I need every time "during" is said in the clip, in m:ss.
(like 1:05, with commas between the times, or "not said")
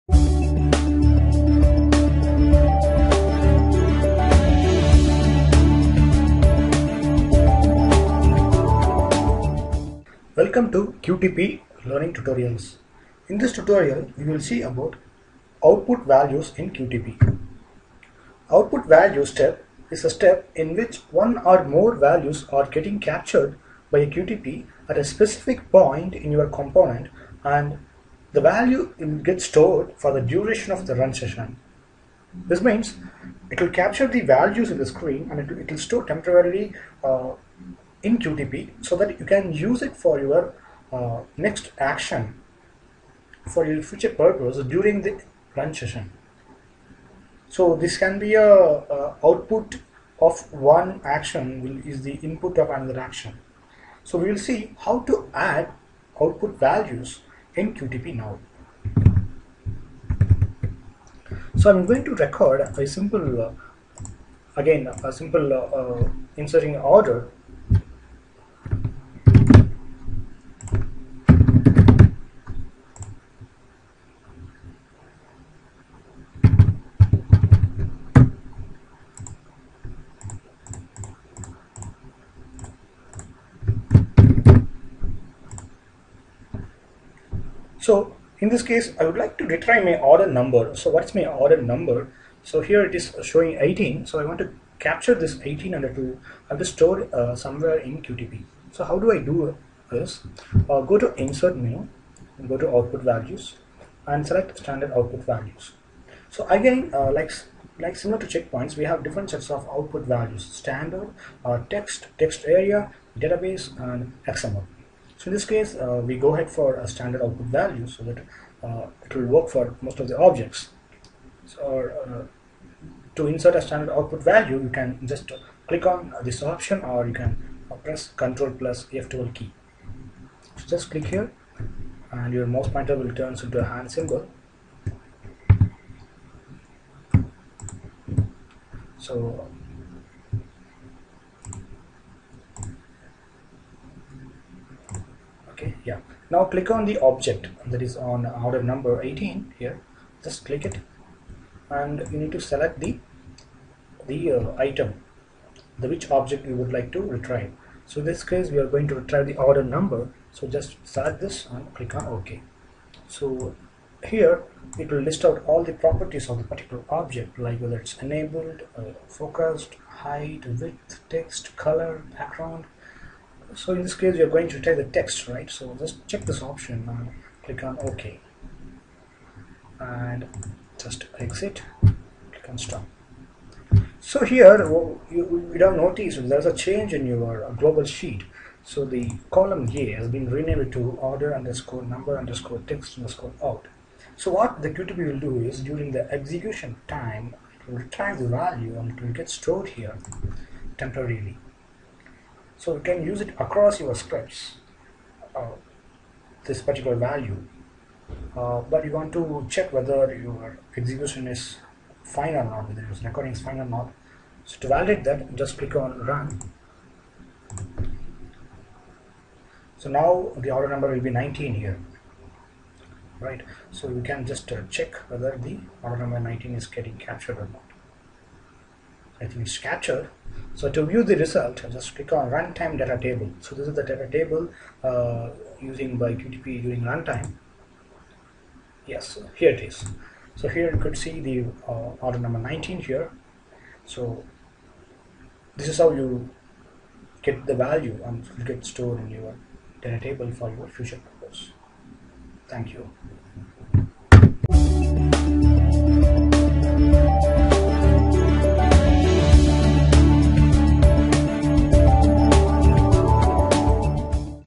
0:44, 3:15, 3:56.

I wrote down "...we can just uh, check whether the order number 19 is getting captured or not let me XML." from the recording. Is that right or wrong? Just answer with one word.
wrong.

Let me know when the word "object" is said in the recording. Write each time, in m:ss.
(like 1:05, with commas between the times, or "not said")
2:00, 2:27, 2:36, 2:47.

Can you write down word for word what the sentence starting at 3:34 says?
So to validate that, just click on run.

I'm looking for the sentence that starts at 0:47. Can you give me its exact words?
So this can be a, a output of one action will, is the input of another action.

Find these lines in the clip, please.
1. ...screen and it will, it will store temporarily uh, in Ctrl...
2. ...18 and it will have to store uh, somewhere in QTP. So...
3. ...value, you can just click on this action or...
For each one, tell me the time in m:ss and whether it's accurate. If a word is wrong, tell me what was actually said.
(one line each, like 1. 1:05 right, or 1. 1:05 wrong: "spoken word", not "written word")
1. 0:34 wrong: "QTP", not "Ctrl"
2. 1:35 right
3. 2:04 wrong: "option", not "action".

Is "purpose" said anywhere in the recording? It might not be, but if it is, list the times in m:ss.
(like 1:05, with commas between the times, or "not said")
0:44, 4:11.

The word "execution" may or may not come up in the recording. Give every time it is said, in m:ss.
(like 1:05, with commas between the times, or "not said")
3:16, 3:30.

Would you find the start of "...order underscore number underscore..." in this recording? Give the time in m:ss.
3:11.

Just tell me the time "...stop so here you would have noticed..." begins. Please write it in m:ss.
3:02.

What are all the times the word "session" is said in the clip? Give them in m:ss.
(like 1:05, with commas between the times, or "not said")
0:31, 0:45.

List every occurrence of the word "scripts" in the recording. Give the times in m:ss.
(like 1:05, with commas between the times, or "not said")
3:23.